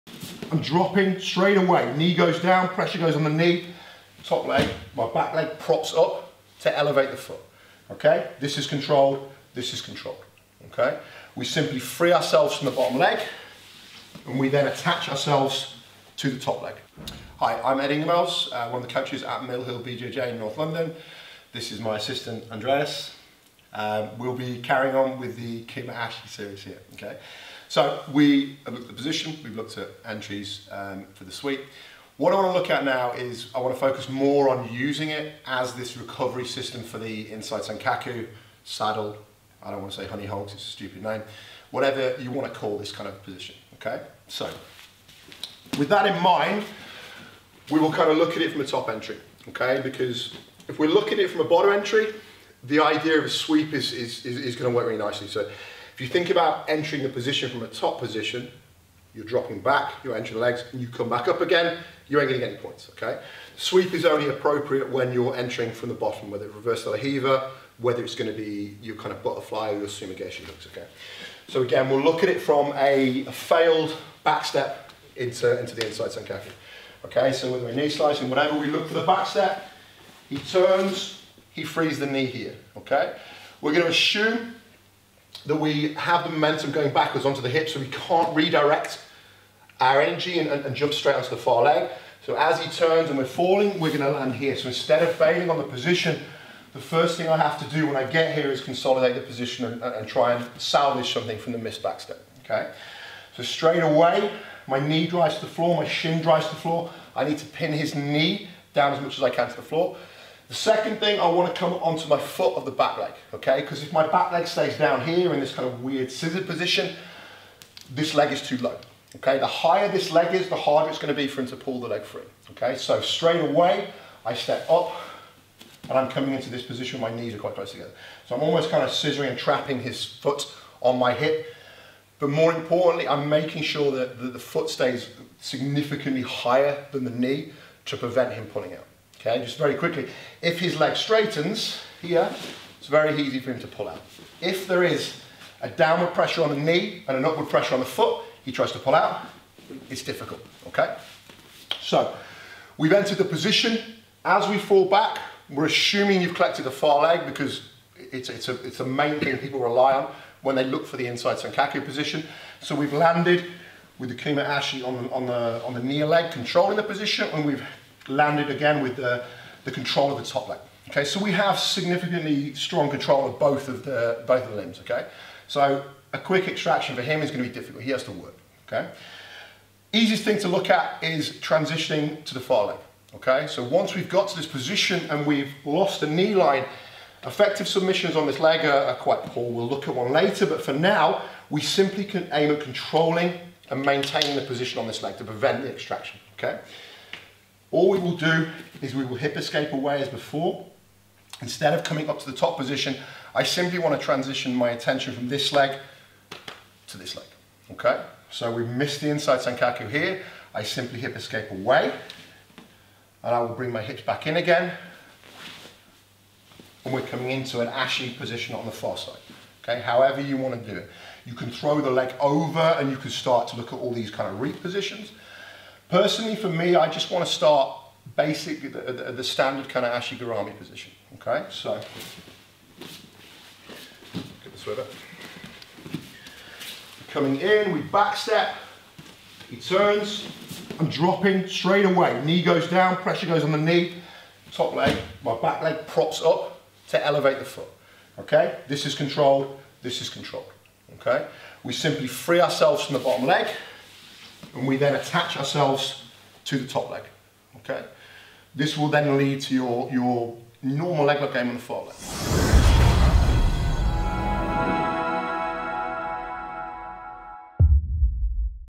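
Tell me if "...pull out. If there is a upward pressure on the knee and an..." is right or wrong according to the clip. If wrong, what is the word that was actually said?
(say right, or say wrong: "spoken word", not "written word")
wrong: "downward", not "upward".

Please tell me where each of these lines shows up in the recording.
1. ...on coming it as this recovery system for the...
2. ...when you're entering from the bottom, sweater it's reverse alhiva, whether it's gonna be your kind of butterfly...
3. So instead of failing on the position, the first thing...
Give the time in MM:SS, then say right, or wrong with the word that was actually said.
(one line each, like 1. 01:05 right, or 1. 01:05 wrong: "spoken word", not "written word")
1. 00:34 wrong: "using", not "coming"
2. 01:04 wrong: "whether", not "sweater"
3. 01:34 right.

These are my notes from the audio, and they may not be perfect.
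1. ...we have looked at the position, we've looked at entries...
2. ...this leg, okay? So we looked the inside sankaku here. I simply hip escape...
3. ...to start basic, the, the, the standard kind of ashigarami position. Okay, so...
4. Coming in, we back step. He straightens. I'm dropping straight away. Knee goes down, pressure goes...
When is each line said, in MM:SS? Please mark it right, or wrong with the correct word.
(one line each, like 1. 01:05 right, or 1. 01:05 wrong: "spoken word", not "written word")
1. 00:28 right
2. 03:26 wrong: "missed", not "looked"
3. 03:47 right
4. 03:57 wrong: "turns", not "straightens".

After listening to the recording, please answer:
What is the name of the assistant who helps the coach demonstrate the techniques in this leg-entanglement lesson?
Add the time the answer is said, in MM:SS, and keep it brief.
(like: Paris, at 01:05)
Andreas, at 00:22.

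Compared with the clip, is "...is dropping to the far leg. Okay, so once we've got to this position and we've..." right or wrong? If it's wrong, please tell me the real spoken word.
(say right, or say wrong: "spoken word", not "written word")
wrong: "transitioning", not "dropping".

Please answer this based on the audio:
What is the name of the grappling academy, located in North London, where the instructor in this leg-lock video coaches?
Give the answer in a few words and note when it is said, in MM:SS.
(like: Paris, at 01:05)
Mill Hill BJJ, at 00:19.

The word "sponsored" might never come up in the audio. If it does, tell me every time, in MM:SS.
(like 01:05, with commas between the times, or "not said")
not said.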